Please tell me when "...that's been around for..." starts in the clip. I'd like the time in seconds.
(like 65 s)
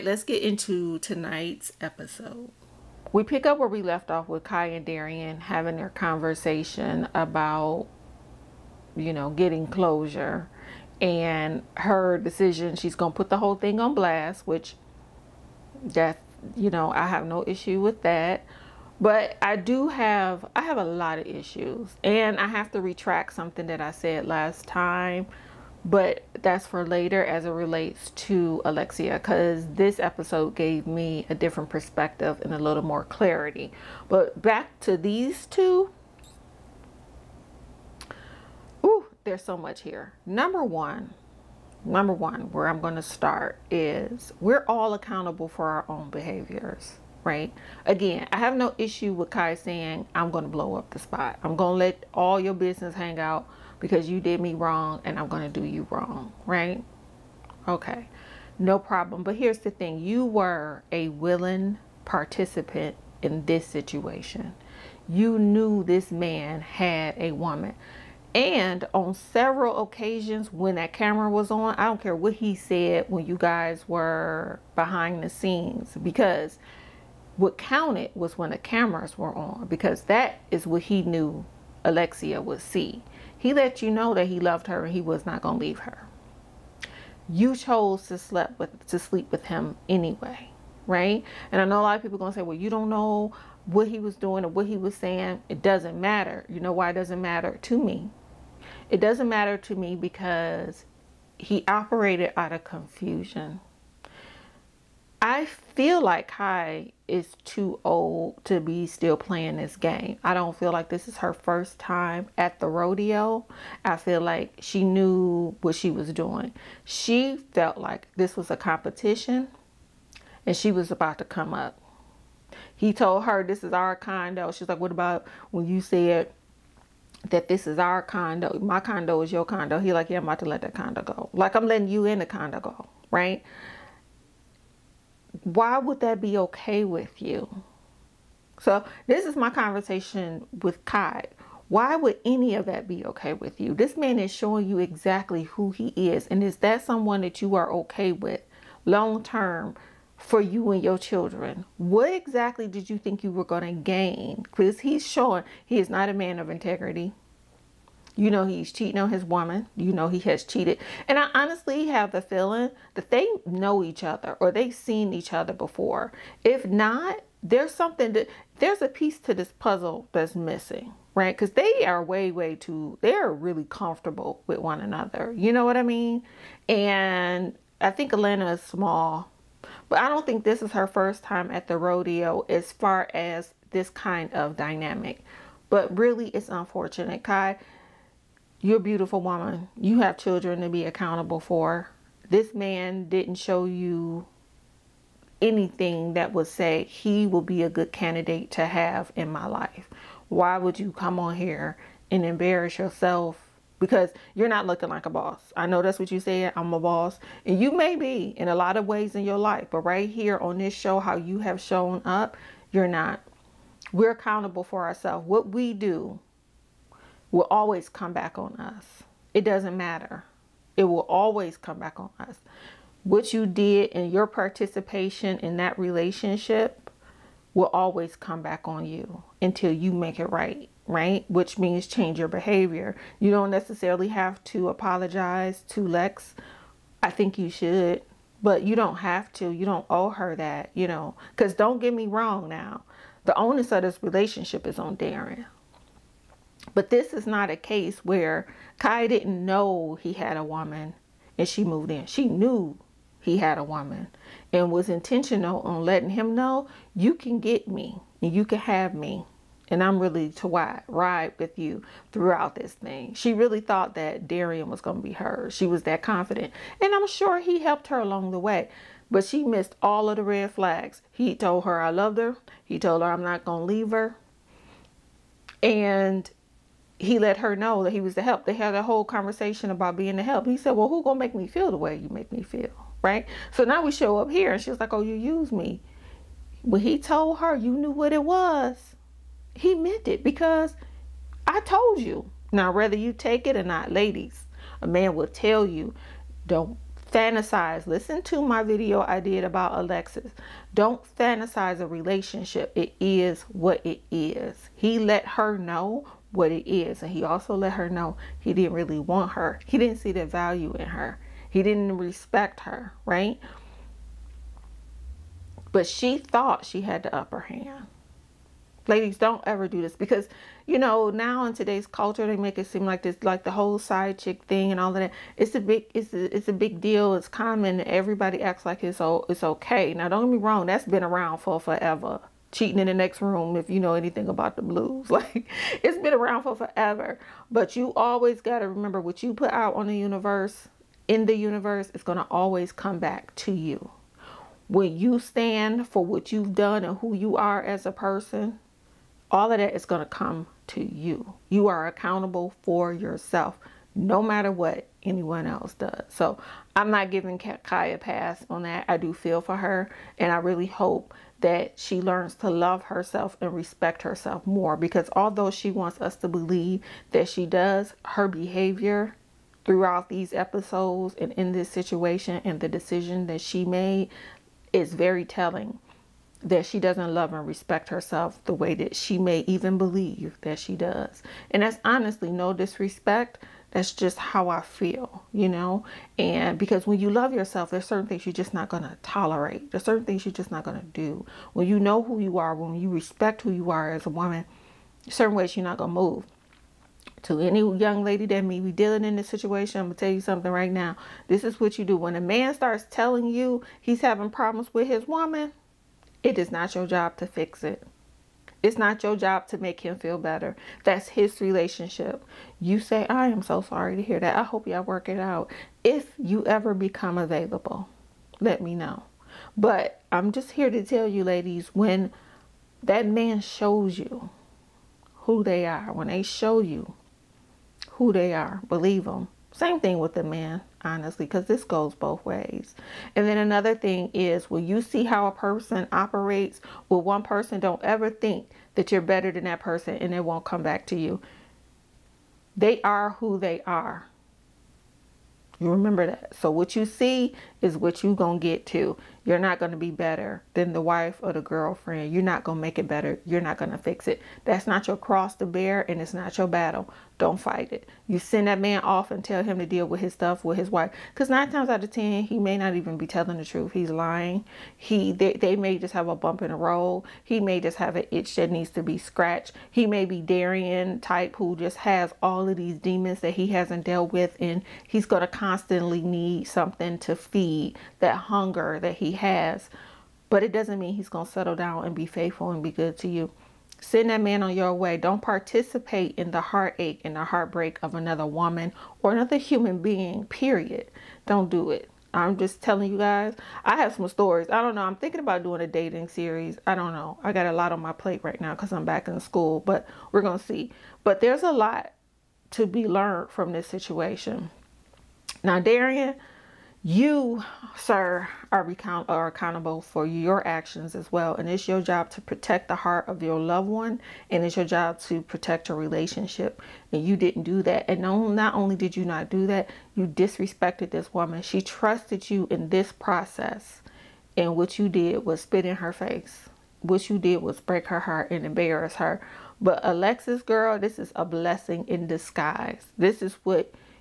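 330 s.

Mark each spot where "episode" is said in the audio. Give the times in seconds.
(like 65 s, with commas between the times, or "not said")
1 s, 29 s, 370 s.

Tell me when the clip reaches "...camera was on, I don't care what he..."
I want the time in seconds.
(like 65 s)
70 s.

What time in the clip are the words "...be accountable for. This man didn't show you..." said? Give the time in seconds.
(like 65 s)
190 s.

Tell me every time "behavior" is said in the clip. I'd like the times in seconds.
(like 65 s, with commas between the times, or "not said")
46 s, 232 s, 368 s.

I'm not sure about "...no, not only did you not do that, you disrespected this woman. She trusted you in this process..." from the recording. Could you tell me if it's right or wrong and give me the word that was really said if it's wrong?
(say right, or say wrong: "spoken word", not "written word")
right.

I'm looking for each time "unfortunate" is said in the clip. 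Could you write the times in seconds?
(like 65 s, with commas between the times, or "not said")
186 s.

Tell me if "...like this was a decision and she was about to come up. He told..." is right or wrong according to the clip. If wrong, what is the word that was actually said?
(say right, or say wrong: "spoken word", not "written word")
wrong: "competition", not "decision".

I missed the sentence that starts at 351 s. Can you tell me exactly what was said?
You are accountable for yourself no matter what anyone else does.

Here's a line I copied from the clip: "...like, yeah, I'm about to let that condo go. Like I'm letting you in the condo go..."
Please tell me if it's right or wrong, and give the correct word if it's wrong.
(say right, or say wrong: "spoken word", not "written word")
right.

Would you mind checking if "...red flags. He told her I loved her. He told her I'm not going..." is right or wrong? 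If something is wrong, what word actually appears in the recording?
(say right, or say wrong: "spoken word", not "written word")
right.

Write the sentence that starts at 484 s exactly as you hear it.
Don't participate in the heartache and the heartbreak of another woman or another human being, period.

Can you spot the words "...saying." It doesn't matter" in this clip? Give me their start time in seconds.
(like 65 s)
94 s.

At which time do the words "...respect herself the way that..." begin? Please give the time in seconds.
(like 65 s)
377 s.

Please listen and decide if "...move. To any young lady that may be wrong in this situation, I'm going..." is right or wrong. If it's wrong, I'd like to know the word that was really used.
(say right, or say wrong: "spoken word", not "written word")
wrong: "dealing", not "wrong".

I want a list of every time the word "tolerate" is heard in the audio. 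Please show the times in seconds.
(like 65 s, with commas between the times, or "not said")
389 s.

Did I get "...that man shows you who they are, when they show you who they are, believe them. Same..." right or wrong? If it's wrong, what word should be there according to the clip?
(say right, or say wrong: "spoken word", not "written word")
right.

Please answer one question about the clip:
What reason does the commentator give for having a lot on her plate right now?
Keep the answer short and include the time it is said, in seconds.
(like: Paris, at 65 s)
back in school, at 498 s.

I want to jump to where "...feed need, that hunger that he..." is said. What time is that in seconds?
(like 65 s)
477 s.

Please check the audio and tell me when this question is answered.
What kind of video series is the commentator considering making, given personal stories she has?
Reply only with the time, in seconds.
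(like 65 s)
495 s.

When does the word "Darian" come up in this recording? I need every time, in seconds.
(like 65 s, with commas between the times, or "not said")
4 s, 244 s, 264 s, 470 s, 505 s.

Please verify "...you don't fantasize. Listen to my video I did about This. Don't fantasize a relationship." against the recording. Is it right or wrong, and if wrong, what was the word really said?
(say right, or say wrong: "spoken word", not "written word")
wrong: "Alexis", not "This".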